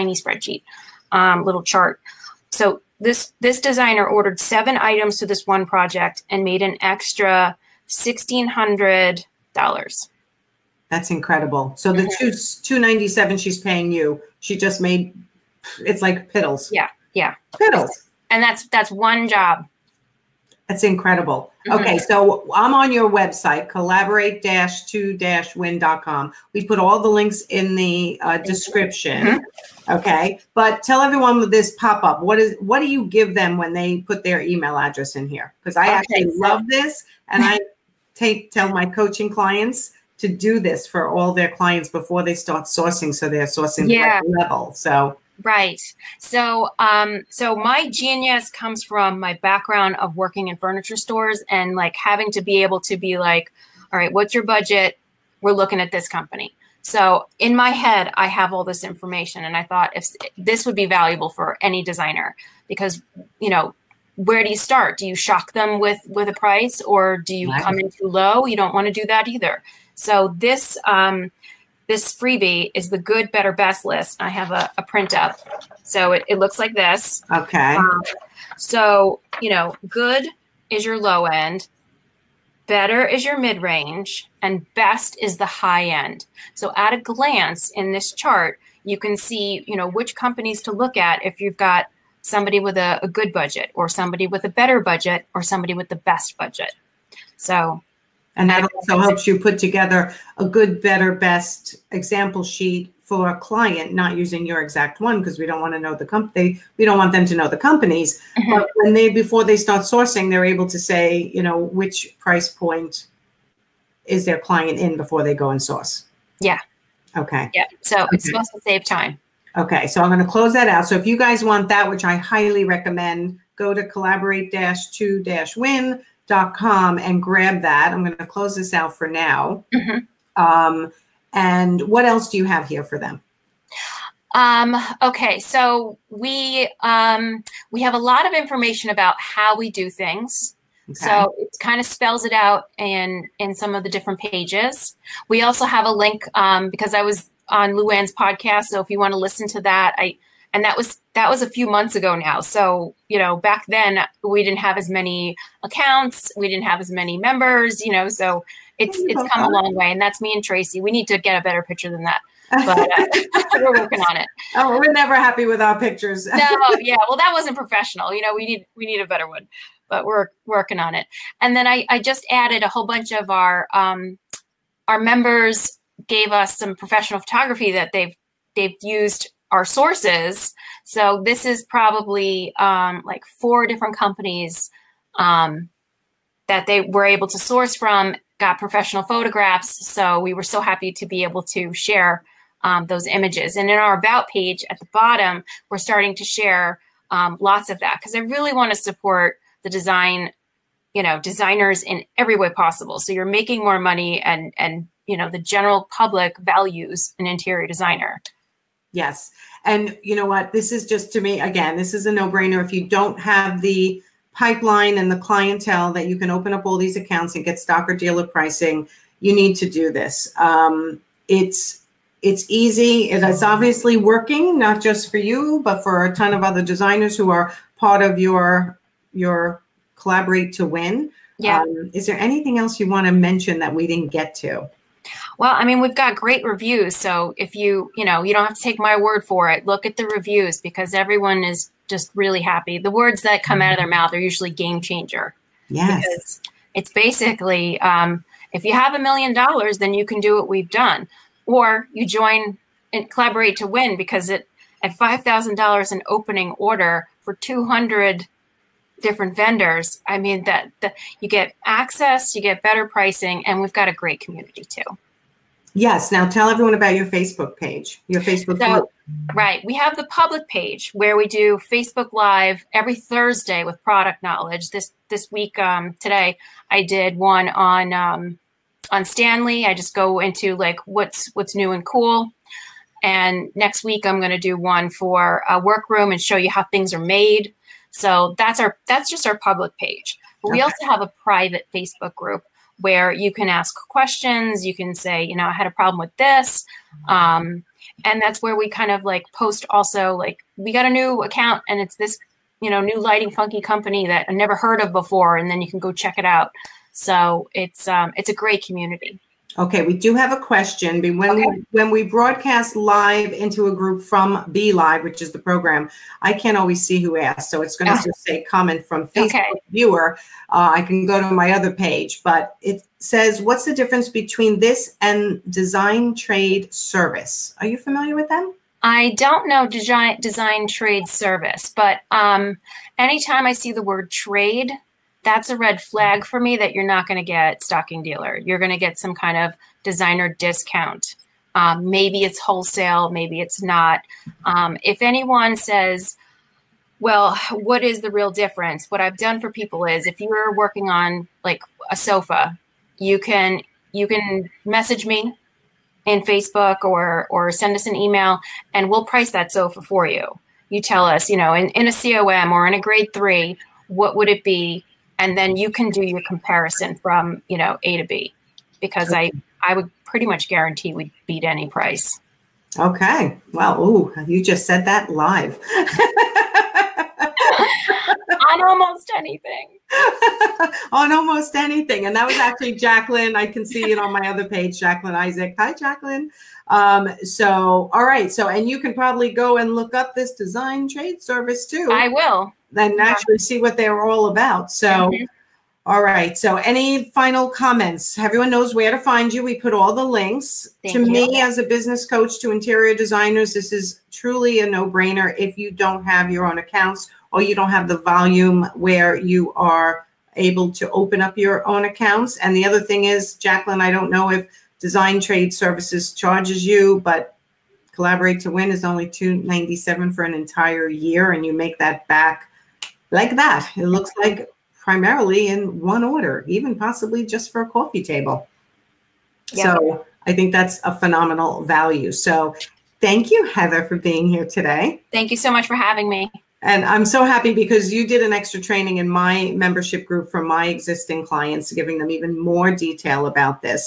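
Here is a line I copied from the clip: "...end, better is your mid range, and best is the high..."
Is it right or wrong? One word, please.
right.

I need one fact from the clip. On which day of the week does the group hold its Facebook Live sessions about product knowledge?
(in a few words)
Thursday.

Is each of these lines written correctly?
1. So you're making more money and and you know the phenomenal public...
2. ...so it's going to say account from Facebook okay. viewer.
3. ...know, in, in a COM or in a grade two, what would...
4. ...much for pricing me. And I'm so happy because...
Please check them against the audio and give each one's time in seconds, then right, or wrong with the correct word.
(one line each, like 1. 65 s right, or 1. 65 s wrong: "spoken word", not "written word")
1. 202 s wrong: "general", not "phenomenal"
2. 317 s wrong: "comment", not "account"
3. 361 s wrong: "three", not "two"
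4. 435 s wrong: "having", not "pricing".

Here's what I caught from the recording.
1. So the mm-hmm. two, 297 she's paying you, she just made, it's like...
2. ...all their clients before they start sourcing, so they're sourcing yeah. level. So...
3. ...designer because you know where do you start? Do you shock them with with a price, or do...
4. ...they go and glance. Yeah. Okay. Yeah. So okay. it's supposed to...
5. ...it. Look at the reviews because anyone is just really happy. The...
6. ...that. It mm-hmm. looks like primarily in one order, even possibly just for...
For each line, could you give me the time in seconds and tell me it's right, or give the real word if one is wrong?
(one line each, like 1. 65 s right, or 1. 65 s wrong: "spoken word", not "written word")
1. 11 s right
2. 41 s right
3. 61 s right
4. 115 s wrong: "source", not "glance"
5. 239 s wrong: "everyone", not "anyone"
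6. 423 s right.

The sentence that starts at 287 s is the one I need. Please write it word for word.
So that's our that's just our public page.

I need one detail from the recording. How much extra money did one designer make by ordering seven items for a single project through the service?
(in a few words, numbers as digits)
$1,600.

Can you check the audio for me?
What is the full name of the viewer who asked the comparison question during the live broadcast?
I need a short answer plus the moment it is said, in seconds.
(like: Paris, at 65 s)
Jacqueline Isaac, at 384 s.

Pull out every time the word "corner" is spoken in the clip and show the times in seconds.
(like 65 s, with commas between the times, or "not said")
not said.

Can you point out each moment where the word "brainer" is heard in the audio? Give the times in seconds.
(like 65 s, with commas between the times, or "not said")
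212 s, 404 s.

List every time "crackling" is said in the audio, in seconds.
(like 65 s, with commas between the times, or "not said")
not said.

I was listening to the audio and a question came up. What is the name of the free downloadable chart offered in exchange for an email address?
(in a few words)
good, better, best list.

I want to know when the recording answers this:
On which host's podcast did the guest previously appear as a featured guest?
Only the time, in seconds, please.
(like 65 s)
147 s.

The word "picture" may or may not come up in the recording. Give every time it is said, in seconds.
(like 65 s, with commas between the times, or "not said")
161 s, 165 s.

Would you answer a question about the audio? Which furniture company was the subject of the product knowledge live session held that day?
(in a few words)
Stanley.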